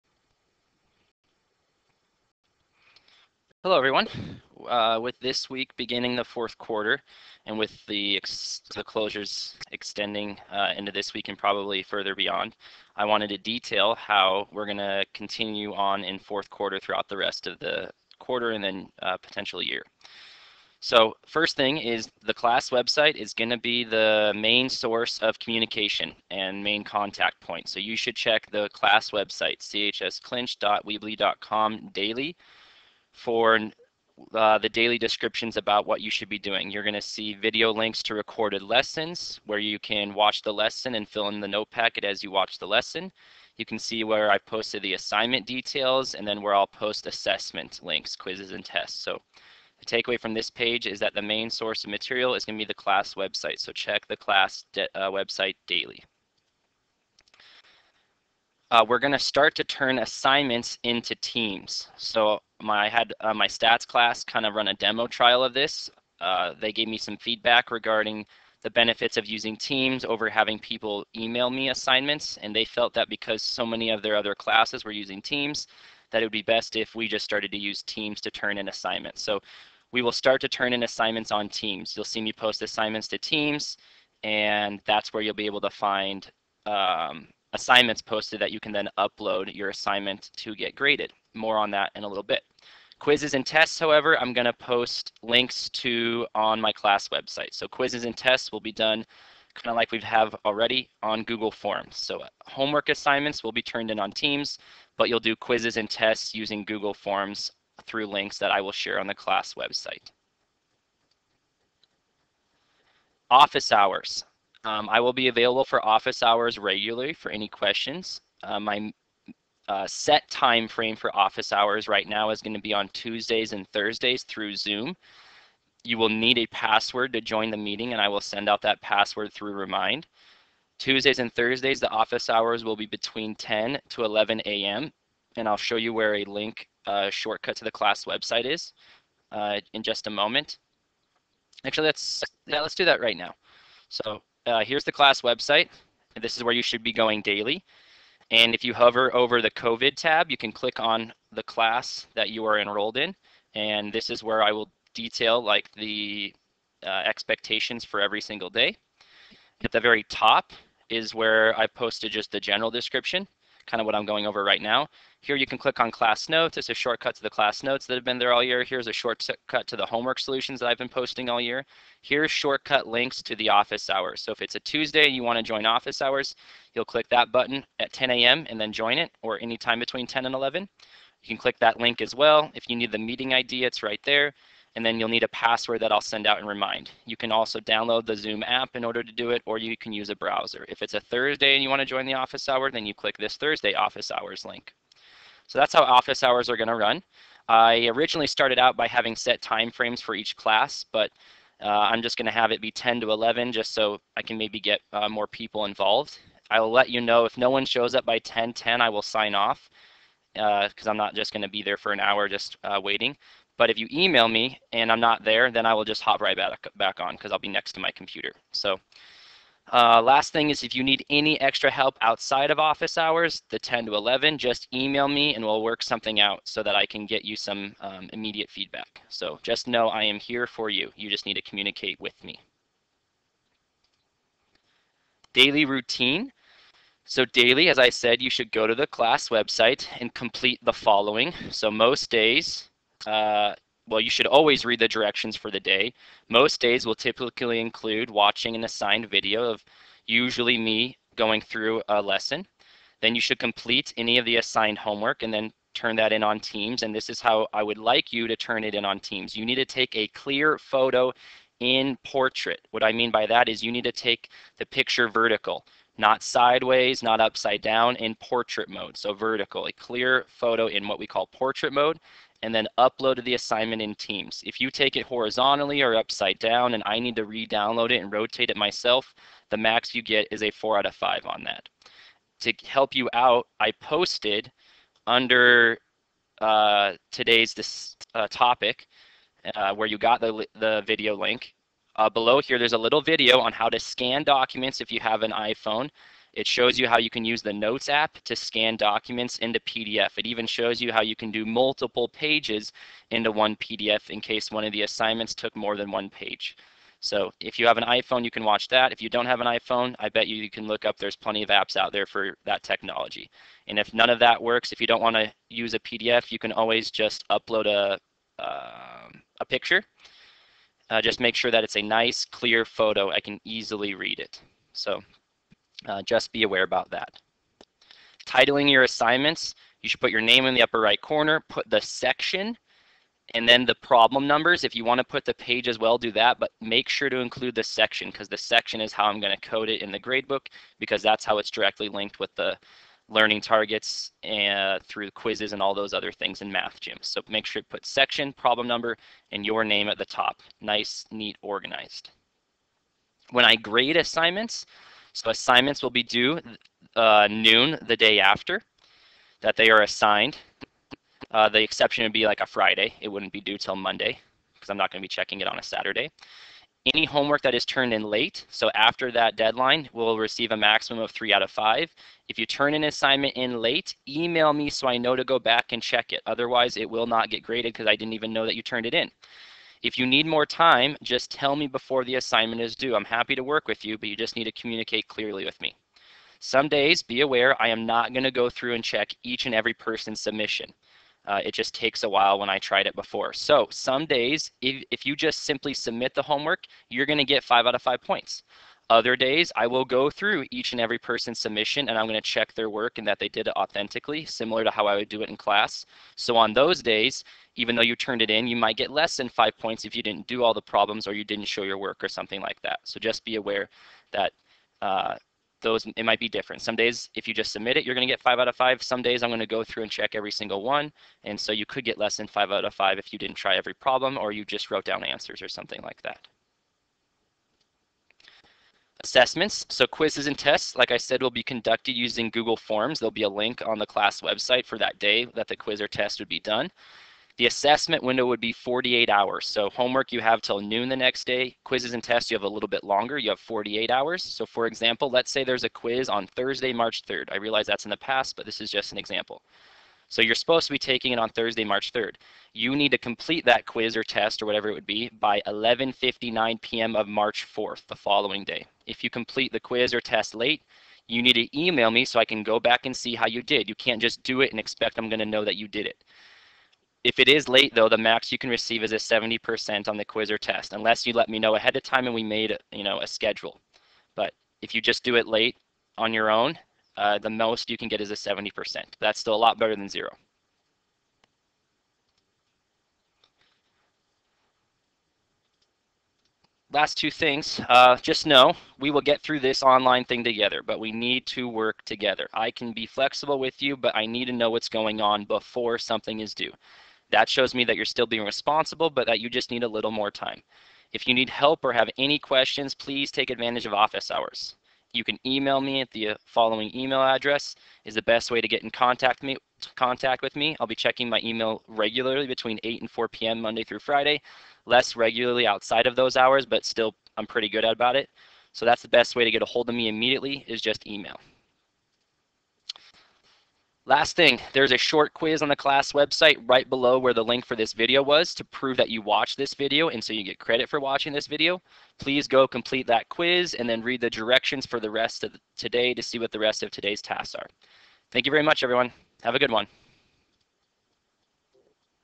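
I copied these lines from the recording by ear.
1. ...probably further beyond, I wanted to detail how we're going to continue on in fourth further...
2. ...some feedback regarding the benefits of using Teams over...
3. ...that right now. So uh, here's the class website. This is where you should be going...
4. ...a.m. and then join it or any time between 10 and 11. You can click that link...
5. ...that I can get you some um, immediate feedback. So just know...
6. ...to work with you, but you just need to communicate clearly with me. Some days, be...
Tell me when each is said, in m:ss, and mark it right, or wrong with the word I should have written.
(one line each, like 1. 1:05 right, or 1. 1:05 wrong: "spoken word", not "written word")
1. 0:11 wrong: "quarter", not "further"
2. 1:06 right
3. 2:22 right
4. 2:58 right
5. 3:46 right
6. 6:23 right.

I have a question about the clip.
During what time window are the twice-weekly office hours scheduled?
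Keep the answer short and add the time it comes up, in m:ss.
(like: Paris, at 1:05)
10 to 11 a.m., at 2:13.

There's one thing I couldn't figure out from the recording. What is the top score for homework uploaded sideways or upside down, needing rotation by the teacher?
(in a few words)
4 out of 5.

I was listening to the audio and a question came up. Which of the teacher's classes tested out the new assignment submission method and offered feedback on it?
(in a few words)
Stats class.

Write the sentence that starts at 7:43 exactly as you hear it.
You can't just do it and expect I'm going to know that you did it.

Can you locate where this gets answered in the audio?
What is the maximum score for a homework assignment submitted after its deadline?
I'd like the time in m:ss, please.
6:11.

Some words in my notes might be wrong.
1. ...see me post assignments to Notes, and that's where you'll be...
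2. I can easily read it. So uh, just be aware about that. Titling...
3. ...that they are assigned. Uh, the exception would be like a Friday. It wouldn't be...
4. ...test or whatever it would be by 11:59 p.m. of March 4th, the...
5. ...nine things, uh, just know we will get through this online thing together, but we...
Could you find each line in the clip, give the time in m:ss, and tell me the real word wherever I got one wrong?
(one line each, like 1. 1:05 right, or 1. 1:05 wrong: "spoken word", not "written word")
1. 1:22 wrong: "Teams", not "Notes"
2. 5:23 right
3. 5:59 right
4. 7:34 right
5. 8:06 wrong: "two", not "nine".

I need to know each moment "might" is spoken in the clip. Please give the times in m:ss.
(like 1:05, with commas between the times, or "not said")
6:48, 6:56.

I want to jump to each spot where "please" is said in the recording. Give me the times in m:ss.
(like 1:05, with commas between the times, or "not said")
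8:22, 8:51.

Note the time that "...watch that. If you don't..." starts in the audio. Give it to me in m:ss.
5:08.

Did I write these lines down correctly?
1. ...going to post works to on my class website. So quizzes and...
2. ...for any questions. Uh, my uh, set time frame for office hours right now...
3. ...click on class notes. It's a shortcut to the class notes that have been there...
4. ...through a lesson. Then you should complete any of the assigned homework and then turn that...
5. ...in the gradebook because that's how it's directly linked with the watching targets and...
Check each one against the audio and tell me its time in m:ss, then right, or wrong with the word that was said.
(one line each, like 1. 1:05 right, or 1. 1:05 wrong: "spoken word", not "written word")
1. 1:34 wrong: "links", not "works"
2. 1:57 right
3. 2:45 right
4. 4:11 right
5. 5:39 wrong: "learning", not "watching".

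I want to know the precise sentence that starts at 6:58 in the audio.
Some days I'm going to go through and check every single one.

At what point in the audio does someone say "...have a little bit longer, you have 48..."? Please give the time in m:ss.
7:22.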